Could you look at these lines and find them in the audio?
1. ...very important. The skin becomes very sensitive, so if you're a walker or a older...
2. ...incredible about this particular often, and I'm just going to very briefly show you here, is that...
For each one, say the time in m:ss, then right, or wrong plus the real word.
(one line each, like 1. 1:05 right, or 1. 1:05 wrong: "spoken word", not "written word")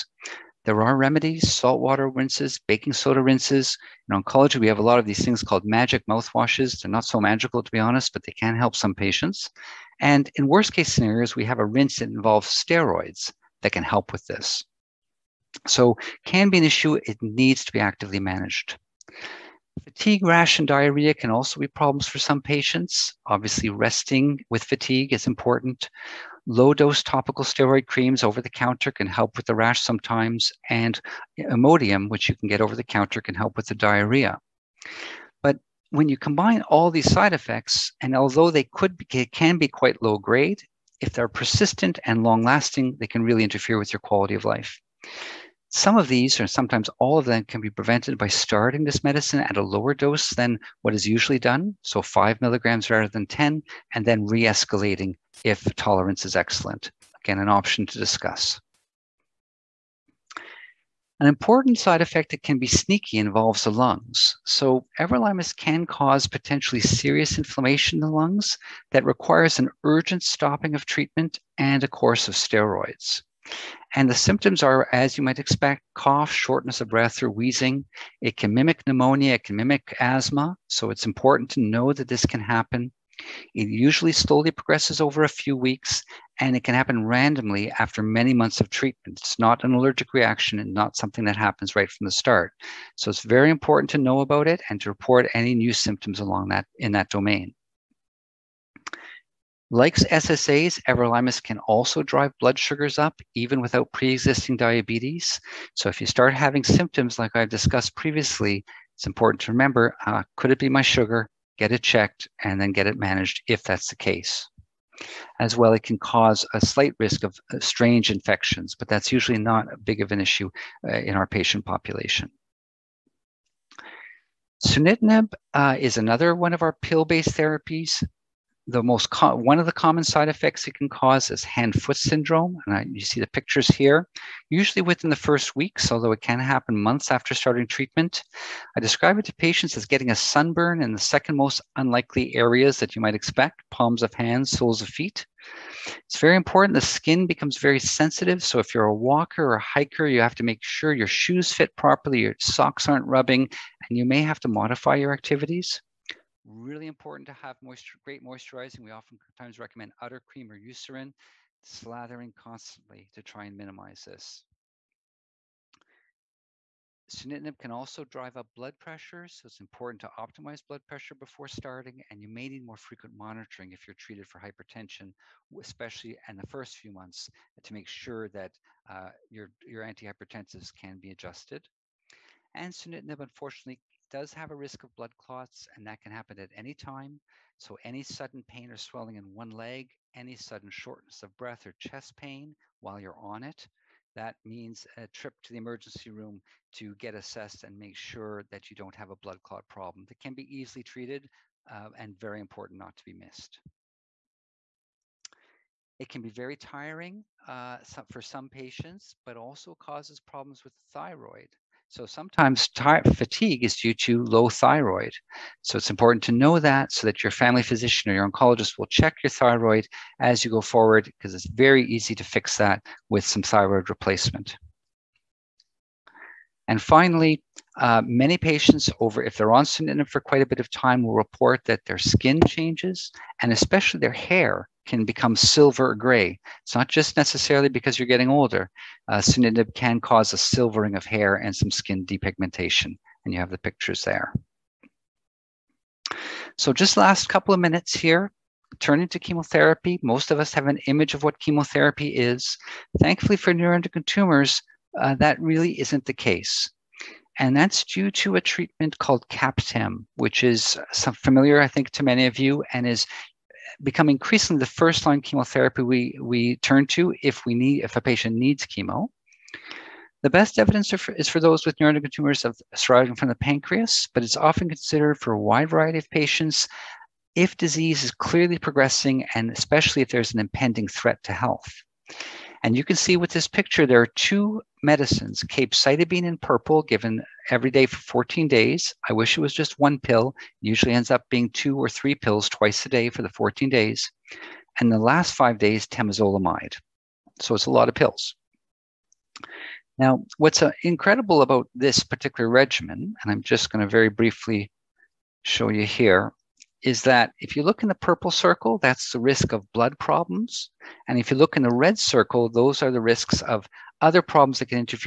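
1. 2:26 wrong: "hiker", not "older"
2. 5:00 wrong: "regimen", not "often".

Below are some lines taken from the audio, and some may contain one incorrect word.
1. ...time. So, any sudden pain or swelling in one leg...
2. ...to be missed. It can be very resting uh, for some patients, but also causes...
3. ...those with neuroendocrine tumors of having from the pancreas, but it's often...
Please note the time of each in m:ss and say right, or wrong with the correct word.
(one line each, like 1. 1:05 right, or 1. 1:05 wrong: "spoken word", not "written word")
1. 3:06 right
2. 3:22 wrong: "tiring", not "resting"
3. 4:31 wrong: "surviving", not "having".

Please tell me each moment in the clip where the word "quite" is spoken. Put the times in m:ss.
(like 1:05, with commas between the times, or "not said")
0:39, 3:50.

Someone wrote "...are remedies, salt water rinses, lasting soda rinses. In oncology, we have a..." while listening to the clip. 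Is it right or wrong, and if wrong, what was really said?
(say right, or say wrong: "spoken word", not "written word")
wrong: "baking", not "lasting".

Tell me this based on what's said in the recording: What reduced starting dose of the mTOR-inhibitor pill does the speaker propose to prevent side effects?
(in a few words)
5 milligrams.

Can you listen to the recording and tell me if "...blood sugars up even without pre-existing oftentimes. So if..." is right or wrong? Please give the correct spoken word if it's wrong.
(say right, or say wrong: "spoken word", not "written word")
wrong: "diabetes", not "oftentimes".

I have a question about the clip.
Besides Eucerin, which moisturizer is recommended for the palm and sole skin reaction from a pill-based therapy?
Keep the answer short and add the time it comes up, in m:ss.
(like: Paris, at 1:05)
udder cream, at 2:39.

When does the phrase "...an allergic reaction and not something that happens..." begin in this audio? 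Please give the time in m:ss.
1:29.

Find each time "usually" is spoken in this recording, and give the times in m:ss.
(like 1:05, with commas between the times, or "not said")
0:51, 1:23, 1:59, 2:14, 4:50.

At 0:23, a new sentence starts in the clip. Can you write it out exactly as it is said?
Obviously, resting with fatigue is important.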